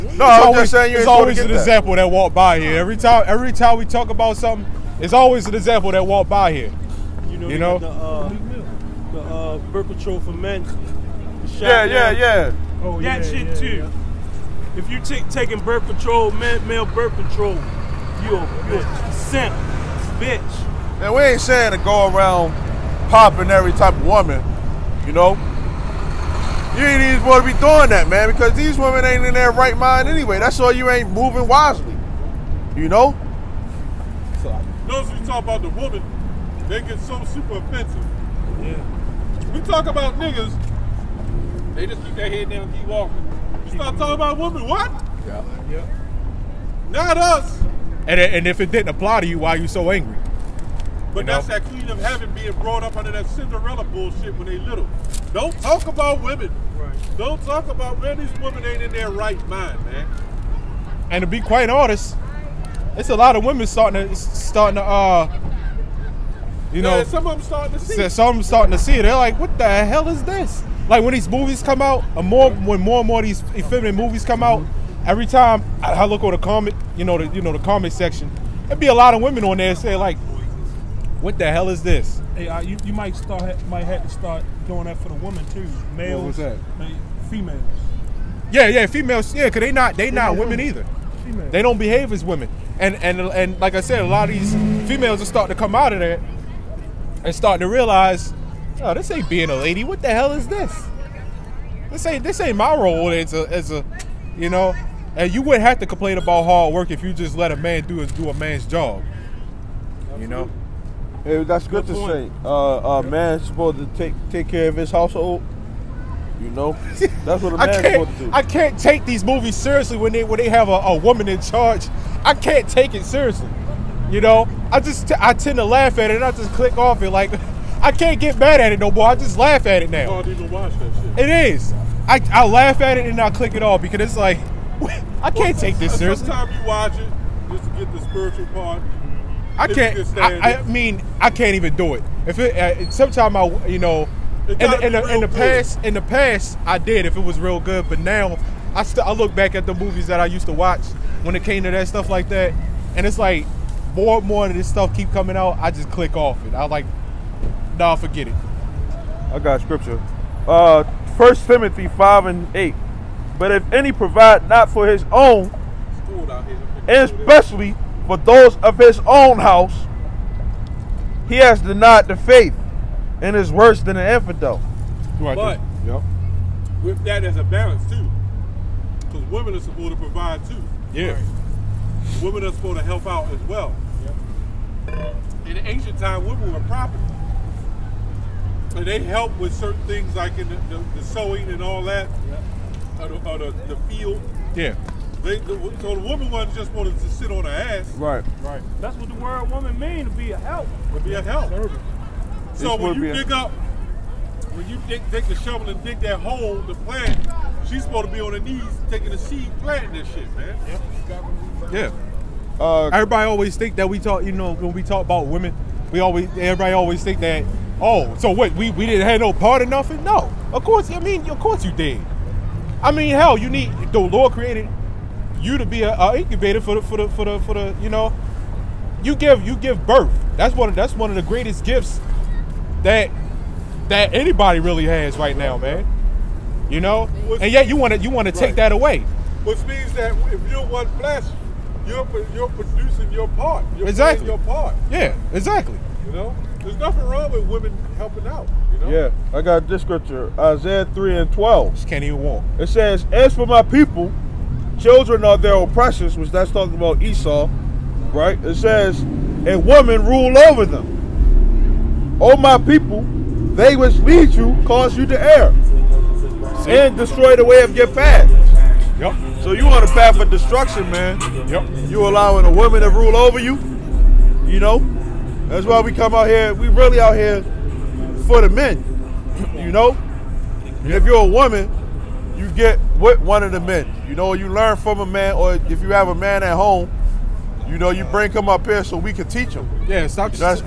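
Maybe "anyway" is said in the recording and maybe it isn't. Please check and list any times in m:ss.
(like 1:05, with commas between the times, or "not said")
0:30.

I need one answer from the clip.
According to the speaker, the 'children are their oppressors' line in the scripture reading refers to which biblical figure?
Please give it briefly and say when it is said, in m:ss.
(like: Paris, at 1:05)
Esau, at 4:17.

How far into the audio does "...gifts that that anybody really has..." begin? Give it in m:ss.
3:51.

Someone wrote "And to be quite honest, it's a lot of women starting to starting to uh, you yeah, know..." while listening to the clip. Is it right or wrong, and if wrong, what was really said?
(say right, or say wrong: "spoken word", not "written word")
right.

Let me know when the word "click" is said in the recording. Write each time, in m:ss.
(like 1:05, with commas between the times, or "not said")
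2:06, 2:13, 2:35.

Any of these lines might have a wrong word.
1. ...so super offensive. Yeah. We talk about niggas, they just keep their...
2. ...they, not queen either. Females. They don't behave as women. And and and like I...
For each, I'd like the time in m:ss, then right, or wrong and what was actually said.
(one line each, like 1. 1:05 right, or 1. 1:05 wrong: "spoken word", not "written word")
1. 0:36 right
2. 1:29 wrong: "women", not "queen".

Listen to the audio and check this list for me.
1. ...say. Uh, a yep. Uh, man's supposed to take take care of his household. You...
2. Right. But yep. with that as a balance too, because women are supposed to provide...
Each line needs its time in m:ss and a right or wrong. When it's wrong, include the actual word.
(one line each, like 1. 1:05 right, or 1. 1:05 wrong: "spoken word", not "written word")
1. 1:52 right
2. 2:55 right.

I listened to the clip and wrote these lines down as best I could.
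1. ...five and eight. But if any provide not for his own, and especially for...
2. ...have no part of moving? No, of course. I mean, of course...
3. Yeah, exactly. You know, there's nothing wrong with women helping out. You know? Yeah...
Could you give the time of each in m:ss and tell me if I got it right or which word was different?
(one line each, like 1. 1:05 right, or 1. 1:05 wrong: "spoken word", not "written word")
1. 2:41 right
2. 3:39 wrong: "nothing", not "moving"
3. 4:04 right.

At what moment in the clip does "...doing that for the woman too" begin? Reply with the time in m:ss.
1:24.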